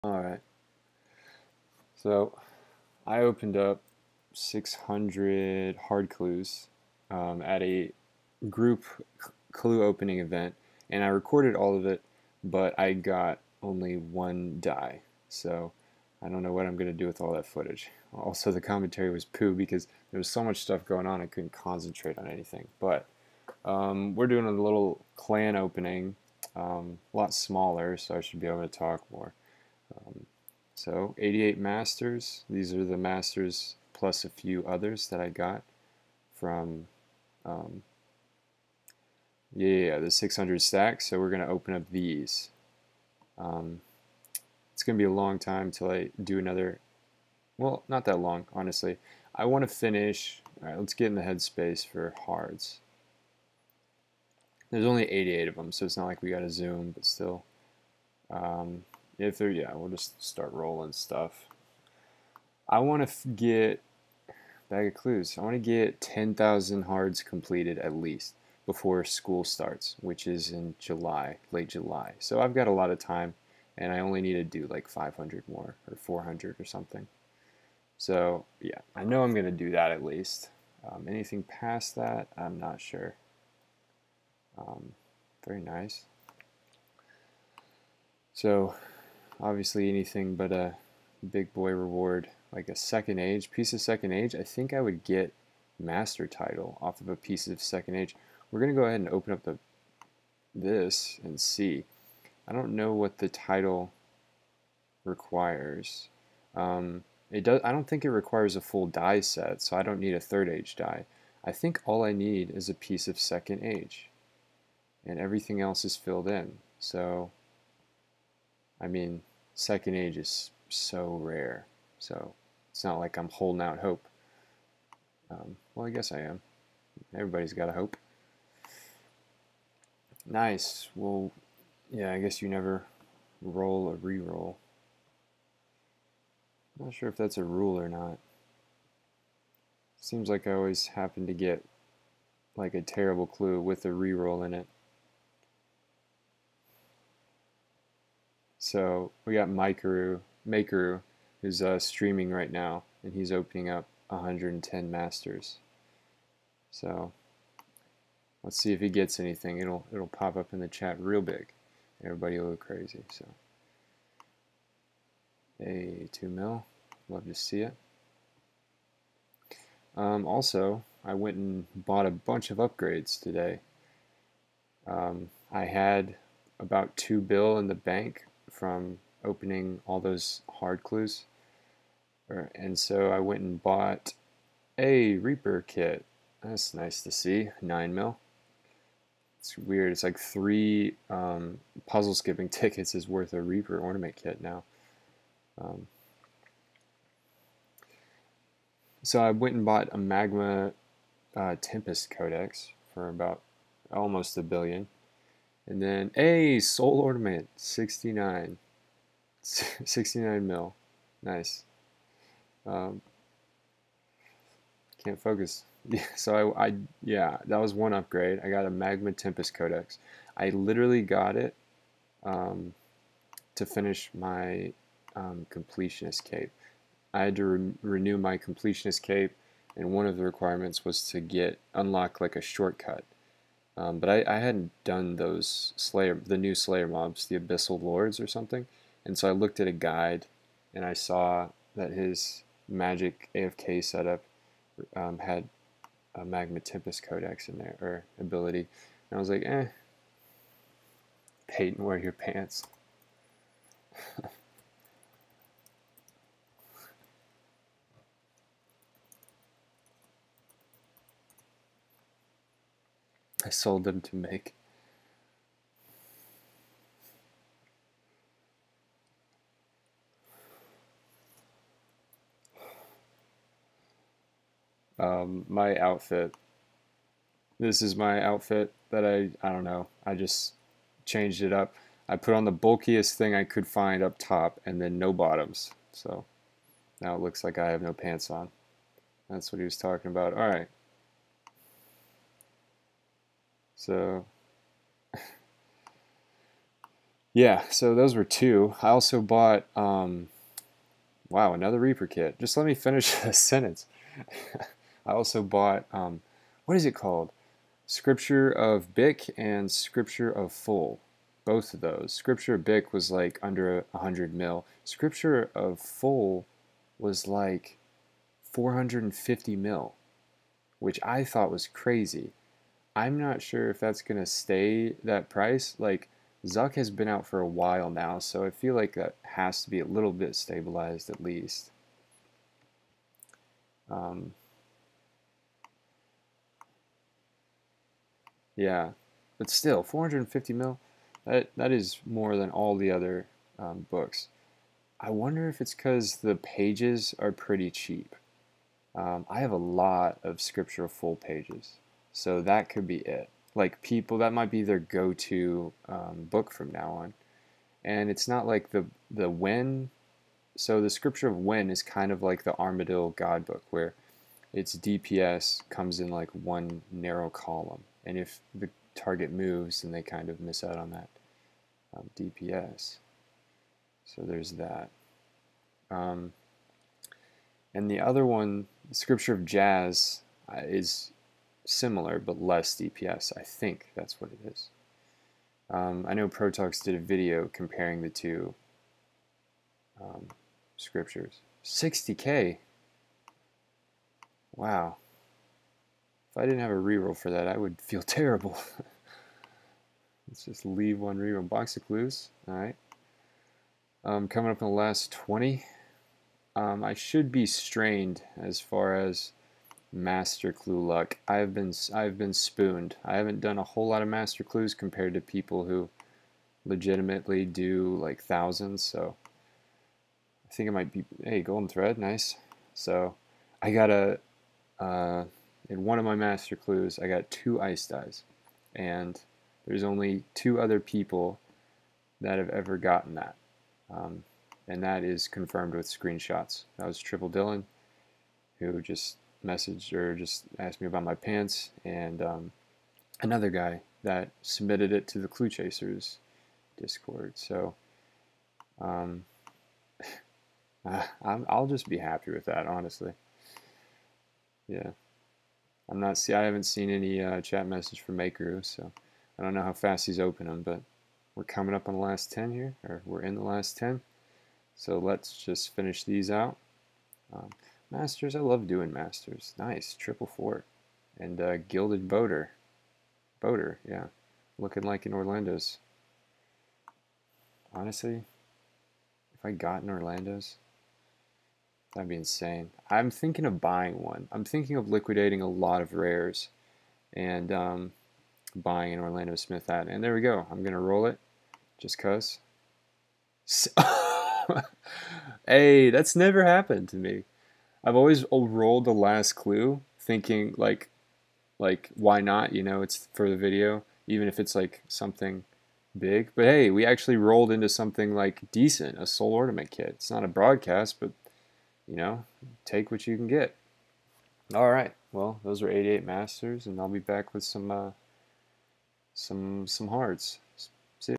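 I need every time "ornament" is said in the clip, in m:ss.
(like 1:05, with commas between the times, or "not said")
3:13, 3:26, 8:29.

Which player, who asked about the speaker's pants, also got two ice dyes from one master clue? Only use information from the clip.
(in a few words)
Triple Dylan.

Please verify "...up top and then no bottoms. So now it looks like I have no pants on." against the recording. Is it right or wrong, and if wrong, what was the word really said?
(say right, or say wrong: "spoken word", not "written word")
right.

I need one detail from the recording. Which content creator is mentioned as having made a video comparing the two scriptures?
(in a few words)
Protoxx.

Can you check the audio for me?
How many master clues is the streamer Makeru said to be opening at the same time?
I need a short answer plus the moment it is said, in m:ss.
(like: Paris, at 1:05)
110, at 2:34.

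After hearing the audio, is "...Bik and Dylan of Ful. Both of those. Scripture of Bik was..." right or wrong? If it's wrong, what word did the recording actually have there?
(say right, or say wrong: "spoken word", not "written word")
wrong: "Scripture", not "Dylan".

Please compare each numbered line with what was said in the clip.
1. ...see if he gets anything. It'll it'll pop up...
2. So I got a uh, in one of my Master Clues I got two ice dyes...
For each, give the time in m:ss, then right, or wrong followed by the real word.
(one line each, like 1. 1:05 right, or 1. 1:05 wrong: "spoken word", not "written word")
1. 2:38 right
2. 7:02 right.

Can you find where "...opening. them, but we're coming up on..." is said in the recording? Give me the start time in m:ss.
7:40.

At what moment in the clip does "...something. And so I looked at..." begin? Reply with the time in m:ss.
3:58.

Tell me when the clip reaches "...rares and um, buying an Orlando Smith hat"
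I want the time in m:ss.
8:05.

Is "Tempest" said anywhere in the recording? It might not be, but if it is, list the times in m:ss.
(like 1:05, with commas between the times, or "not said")
3:21, 3:39, 4:06.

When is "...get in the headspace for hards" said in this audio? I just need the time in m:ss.
0:50.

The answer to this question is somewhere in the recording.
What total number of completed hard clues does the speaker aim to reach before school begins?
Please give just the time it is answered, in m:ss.
1:06.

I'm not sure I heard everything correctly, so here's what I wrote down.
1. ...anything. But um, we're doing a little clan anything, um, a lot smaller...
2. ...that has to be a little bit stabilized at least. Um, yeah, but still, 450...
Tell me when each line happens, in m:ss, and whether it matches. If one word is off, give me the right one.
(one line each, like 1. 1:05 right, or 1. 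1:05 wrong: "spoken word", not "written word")
1. 0:22 wrong: "opening", not "anything"
2. 5:28 right.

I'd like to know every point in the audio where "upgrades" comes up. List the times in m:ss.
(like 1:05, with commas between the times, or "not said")
2:52, 3:37.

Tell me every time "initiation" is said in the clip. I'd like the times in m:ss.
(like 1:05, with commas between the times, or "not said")
not said.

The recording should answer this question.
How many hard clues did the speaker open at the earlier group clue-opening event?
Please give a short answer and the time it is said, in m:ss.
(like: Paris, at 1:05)
600, at 0:04.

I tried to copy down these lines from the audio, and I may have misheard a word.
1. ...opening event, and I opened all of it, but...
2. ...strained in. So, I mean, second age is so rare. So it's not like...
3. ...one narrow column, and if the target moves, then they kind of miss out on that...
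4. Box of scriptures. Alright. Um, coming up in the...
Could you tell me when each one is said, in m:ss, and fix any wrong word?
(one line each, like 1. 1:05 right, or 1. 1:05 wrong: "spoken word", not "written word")
1. 0:09 wrong: "recorded", not "opened"
2. 1:55 wrong: "filled", not "strained"
3. 6:06 right
4. 6:41 wrong: "clues", not "scriptures".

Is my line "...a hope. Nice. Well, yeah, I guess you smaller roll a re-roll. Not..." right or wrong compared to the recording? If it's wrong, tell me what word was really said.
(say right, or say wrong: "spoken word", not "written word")
wrong: "never", not "smaller".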